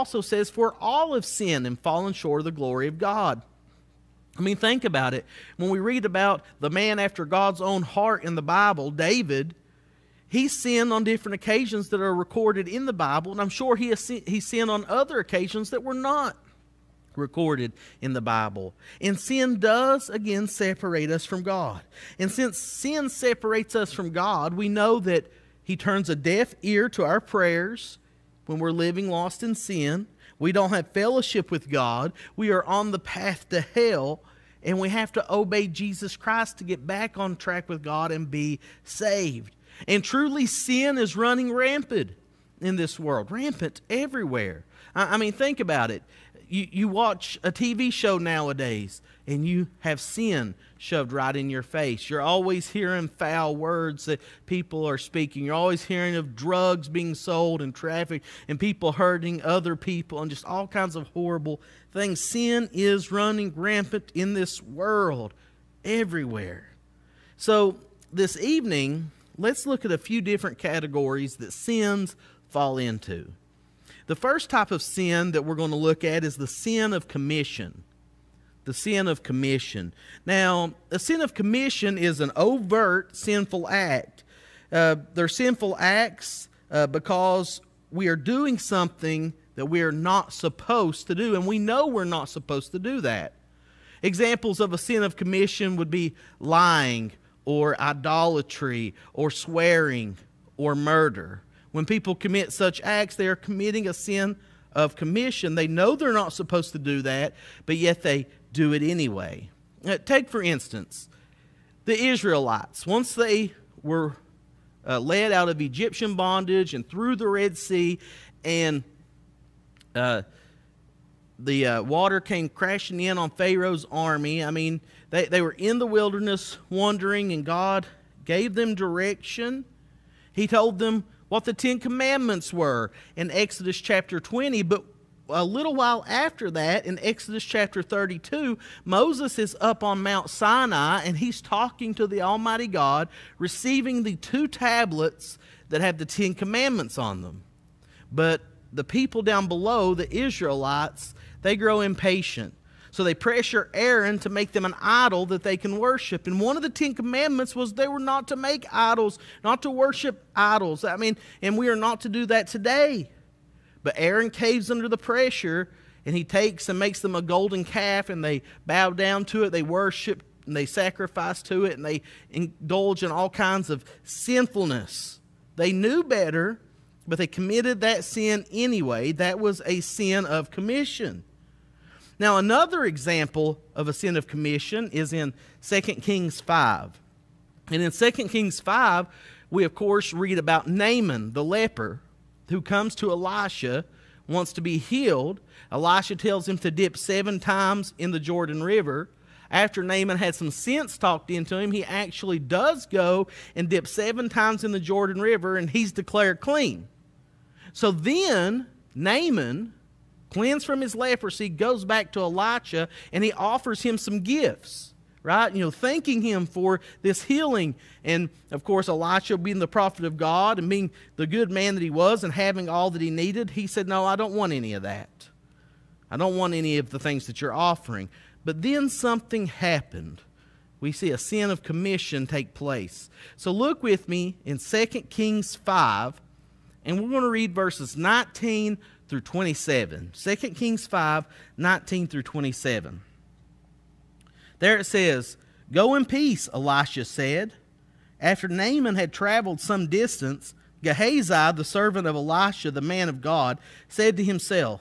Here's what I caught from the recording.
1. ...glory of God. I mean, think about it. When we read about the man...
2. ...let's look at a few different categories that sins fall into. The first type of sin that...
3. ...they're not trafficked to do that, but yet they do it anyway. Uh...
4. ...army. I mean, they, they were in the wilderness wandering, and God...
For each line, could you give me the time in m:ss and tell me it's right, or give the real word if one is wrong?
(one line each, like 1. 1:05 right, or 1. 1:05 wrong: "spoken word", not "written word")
1. 0:02 right
2. 1:09 right
3. 1:45 wrong: "supposed", not "trafficked"
4. 2:03 right.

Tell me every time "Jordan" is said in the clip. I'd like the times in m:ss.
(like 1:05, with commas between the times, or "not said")
3:18, 3:24.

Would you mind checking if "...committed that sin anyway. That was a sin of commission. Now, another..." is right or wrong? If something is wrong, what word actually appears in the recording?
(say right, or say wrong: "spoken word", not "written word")
right.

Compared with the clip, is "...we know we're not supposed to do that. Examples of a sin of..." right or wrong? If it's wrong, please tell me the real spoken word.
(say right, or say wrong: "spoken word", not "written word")
right.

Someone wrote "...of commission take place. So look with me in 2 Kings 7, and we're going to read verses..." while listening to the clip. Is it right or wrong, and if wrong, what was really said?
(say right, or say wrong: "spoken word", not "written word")
wrong: "5", not "7".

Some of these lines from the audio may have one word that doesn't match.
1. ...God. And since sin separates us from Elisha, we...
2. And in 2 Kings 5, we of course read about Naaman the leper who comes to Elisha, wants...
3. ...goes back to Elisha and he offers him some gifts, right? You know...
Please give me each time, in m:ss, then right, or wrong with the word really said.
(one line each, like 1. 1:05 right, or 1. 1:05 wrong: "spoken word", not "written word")
1. 0:21 wrong: "God", not "Elisha"
2. 3:07 right
3. 3:31 right.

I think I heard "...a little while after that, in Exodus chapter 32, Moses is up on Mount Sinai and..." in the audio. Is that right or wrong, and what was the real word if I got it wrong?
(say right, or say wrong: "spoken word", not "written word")
right.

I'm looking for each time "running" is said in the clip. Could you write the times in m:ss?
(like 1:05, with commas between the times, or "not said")
0:41, 1:03.